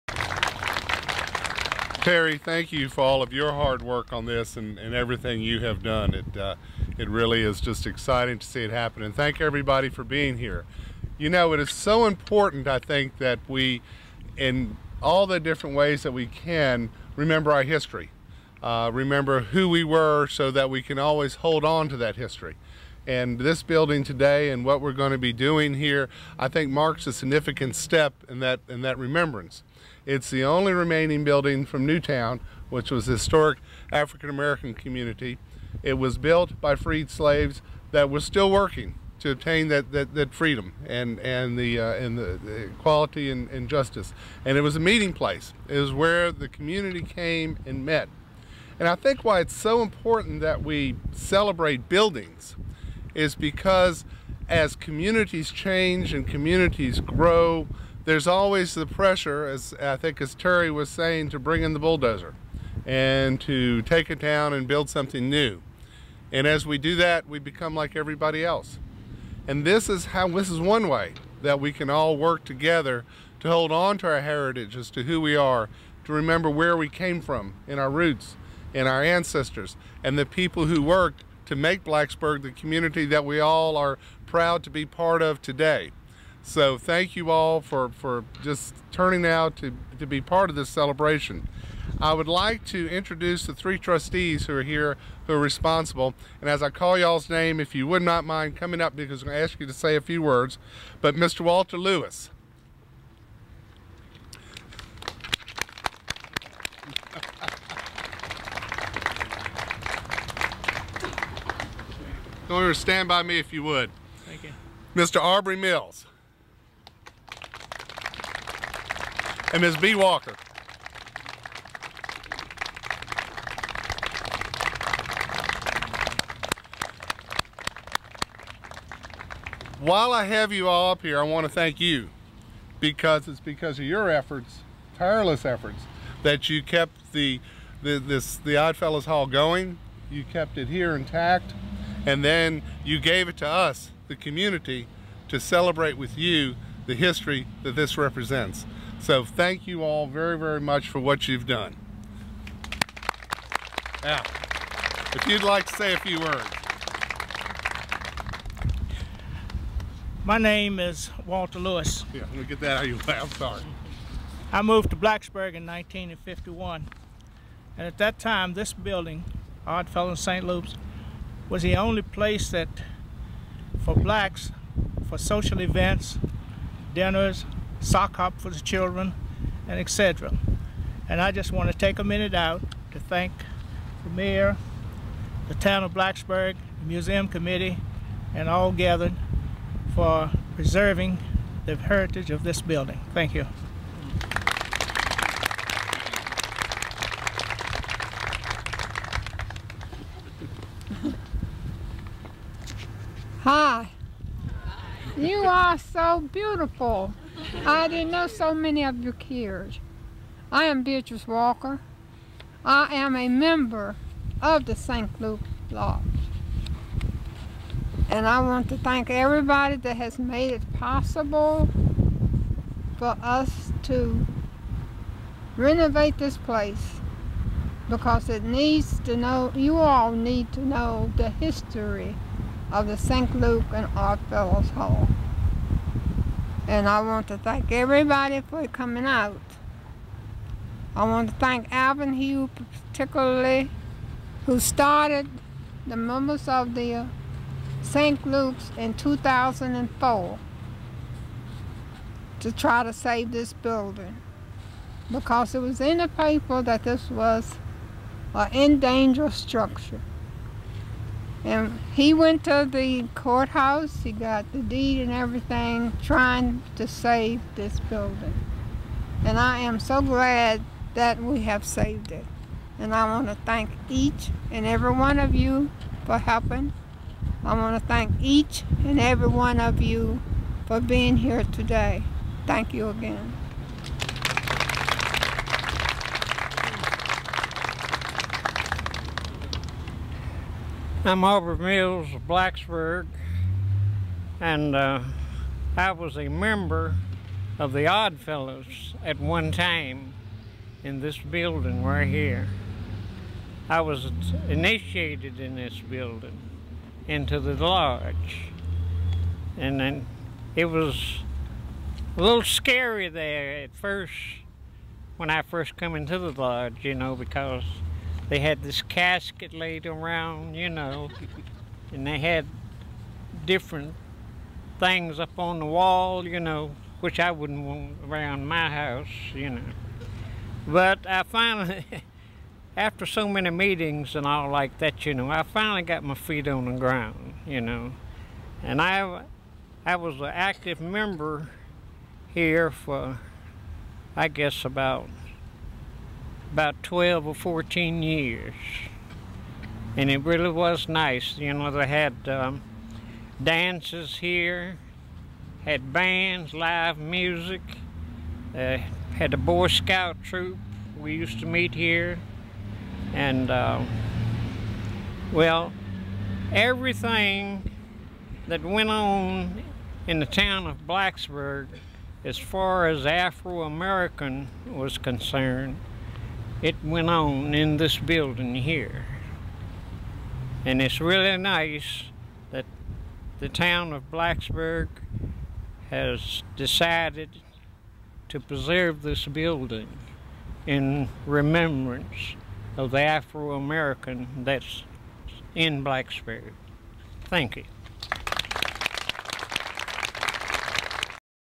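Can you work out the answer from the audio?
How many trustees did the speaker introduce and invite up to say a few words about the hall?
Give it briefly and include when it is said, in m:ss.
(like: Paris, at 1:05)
3, at 1:33.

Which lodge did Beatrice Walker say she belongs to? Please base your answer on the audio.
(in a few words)
St. Luke Lodge.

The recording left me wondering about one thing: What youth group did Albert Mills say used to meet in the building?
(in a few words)
Boy Scout troop.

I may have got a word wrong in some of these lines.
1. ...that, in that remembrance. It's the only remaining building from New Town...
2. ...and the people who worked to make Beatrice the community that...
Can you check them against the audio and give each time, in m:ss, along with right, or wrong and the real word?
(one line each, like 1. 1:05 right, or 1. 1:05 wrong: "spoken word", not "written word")
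1. 0:28 right
2. 1:20 wrong: "Blacksburg", not "Beatrice".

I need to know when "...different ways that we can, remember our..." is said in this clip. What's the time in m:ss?
0:15.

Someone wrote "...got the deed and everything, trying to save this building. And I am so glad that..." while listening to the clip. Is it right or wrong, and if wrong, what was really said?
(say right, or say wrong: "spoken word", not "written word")
right.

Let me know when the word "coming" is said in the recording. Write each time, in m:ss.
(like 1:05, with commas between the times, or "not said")
1:38, 3:58.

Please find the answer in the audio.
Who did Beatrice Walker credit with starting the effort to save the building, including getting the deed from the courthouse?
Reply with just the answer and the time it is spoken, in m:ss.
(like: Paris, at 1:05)
Alvin Hugh, at 4:01.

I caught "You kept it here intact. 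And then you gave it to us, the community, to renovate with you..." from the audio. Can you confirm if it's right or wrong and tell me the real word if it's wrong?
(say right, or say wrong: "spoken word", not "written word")
wrong: "celebrate", not "renovate".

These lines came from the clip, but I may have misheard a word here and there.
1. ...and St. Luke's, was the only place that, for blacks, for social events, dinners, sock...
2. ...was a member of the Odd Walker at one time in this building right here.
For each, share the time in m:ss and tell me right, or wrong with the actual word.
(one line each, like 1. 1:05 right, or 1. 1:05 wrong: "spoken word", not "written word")
1. 2:50 right
2. 4:55 wrong: "Fellows", not "Walker".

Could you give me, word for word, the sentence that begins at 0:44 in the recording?
And it was a meeting place.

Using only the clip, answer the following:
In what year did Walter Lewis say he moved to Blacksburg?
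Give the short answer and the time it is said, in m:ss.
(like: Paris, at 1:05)
1951, at 2:45.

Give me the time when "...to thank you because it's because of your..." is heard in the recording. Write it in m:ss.
2:11.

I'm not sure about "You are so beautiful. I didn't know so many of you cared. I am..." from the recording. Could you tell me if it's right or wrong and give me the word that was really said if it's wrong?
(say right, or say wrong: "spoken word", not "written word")
right.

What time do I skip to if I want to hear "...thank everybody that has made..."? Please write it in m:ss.
3:38.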